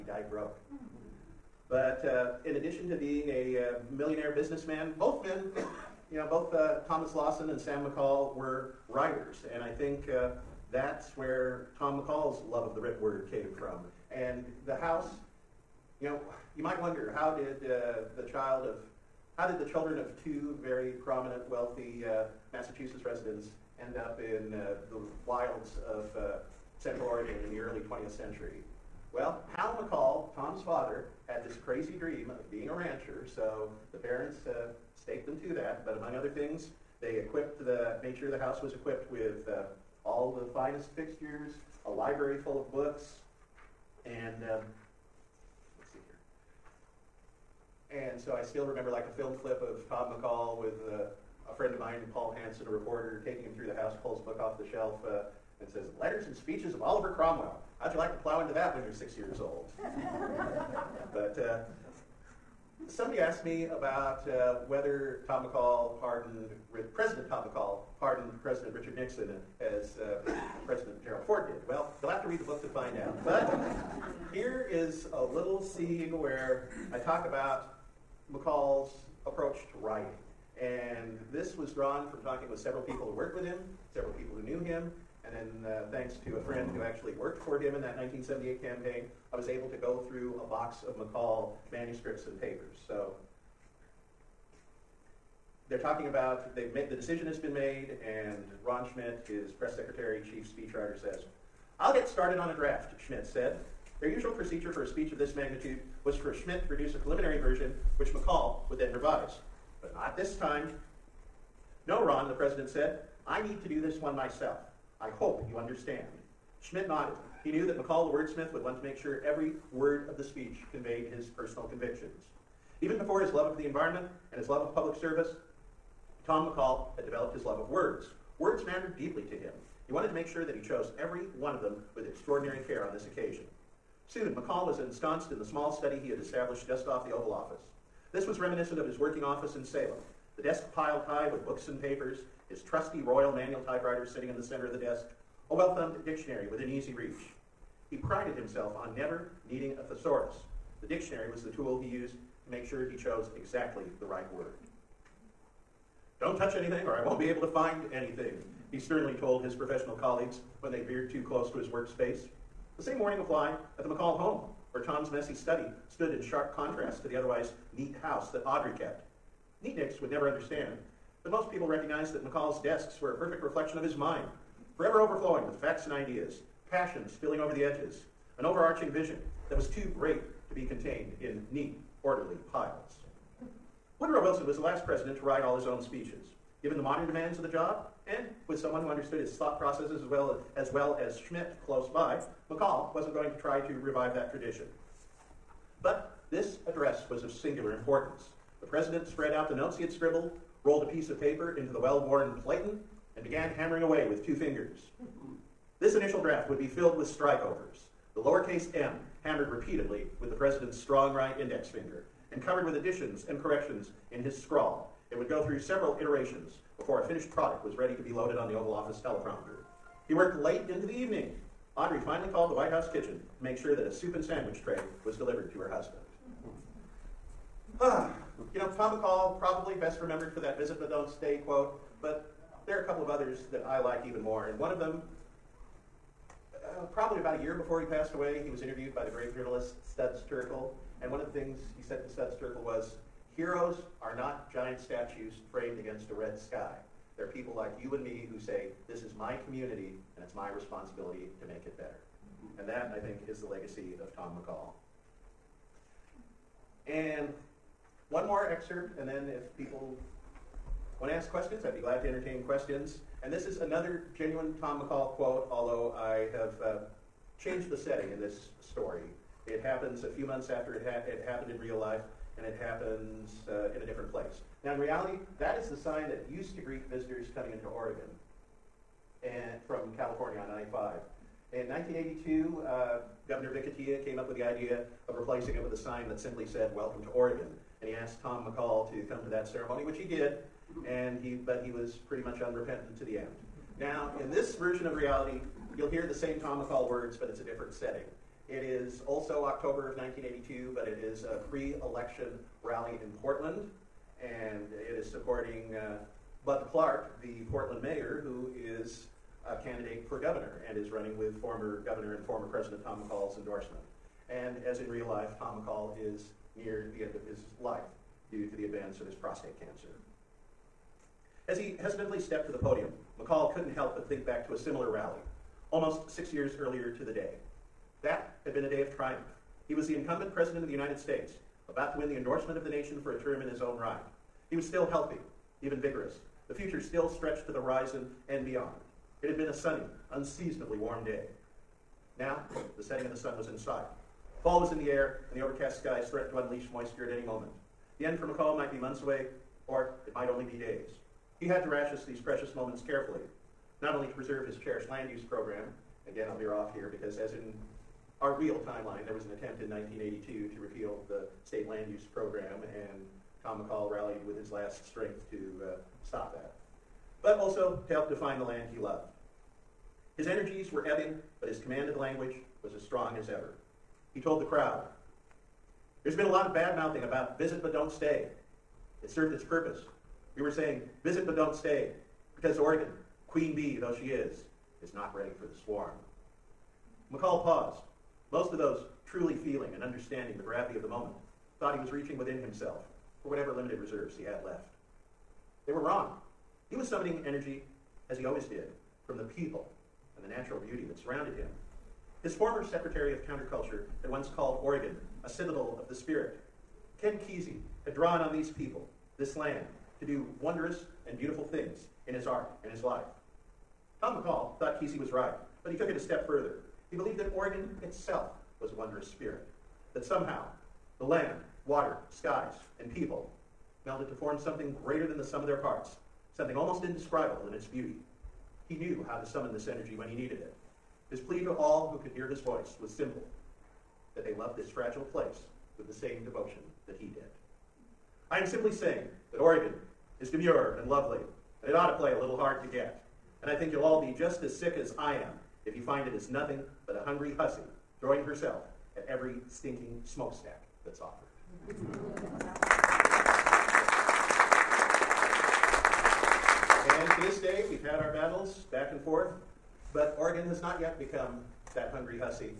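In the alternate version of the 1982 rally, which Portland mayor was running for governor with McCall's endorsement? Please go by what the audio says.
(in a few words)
Bud Clark.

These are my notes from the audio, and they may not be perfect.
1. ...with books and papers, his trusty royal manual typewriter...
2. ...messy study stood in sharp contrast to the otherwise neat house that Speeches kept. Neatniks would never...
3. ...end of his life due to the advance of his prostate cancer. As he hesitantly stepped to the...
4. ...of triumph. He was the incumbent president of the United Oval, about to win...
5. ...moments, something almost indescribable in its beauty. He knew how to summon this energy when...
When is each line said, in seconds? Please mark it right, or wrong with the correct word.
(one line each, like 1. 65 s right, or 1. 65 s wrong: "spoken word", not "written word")
1. 141 s right
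2. 165 s wrong: "Audrey", not "Speeches"
3. 317 s right
4. 328 s wrong: "States", not "Oval"
5. 425 s wrong: "parts", not "moments".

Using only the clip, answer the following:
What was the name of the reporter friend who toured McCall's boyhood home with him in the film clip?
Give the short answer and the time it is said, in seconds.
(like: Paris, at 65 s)
Paul Hanson, at 52 s.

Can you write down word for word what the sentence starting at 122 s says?
Even before his love of the environment and his love of public service, Tom McCall had developed his love of words.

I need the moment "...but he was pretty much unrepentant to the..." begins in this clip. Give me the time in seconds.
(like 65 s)
291 s.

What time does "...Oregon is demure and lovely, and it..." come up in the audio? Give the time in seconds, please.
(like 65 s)
439 s.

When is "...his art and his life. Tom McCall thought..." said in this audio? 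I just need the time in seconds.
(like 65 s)
412 s.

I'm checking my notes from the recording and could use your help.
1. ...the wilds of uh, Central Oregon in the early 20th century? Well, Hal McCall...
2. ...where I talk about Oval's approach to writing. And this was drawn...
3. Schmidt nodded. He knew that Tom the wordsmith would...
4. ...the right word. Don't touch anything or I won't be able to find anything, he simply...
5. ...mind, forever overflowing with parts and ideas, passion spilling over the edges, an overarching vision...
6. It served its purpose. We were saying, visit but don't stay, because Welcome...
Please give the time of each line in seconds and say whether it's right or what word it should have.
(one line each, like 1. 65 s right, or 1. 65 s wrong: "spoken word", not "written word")
1. 24 s right
2. 76 s wrong: "McCall", not "Oval"
3. 116 s wrong: "McCall", not "Tom"
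4. 153 s wrong: "sternly", not "simply"
5. 173 s wrong: "facts", not "parts"
6. 379 s wrong: "Oregon", not "Welcome".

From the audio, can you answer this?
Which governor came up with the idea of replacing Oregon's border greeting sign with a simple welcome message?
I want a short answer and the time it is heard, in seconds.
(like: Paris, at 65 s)
Vic Atiyeh, at 283 s.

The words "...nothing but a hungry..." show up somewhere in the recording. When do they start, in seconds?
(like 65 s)
446 s.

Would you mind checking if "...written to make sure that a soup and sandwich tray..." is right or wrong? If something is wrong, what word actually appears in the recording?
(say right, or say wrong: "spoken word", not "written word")
wrong: "kitchen", not "written".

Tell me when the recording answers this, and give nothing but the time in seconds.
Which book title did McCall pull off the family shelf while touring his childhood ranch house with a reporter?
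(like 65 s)
55 s.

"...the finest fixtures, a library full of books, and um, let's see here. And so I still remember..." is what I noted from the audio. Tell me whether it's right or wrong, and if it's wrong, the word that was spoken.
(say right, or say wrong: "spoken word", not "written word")
right.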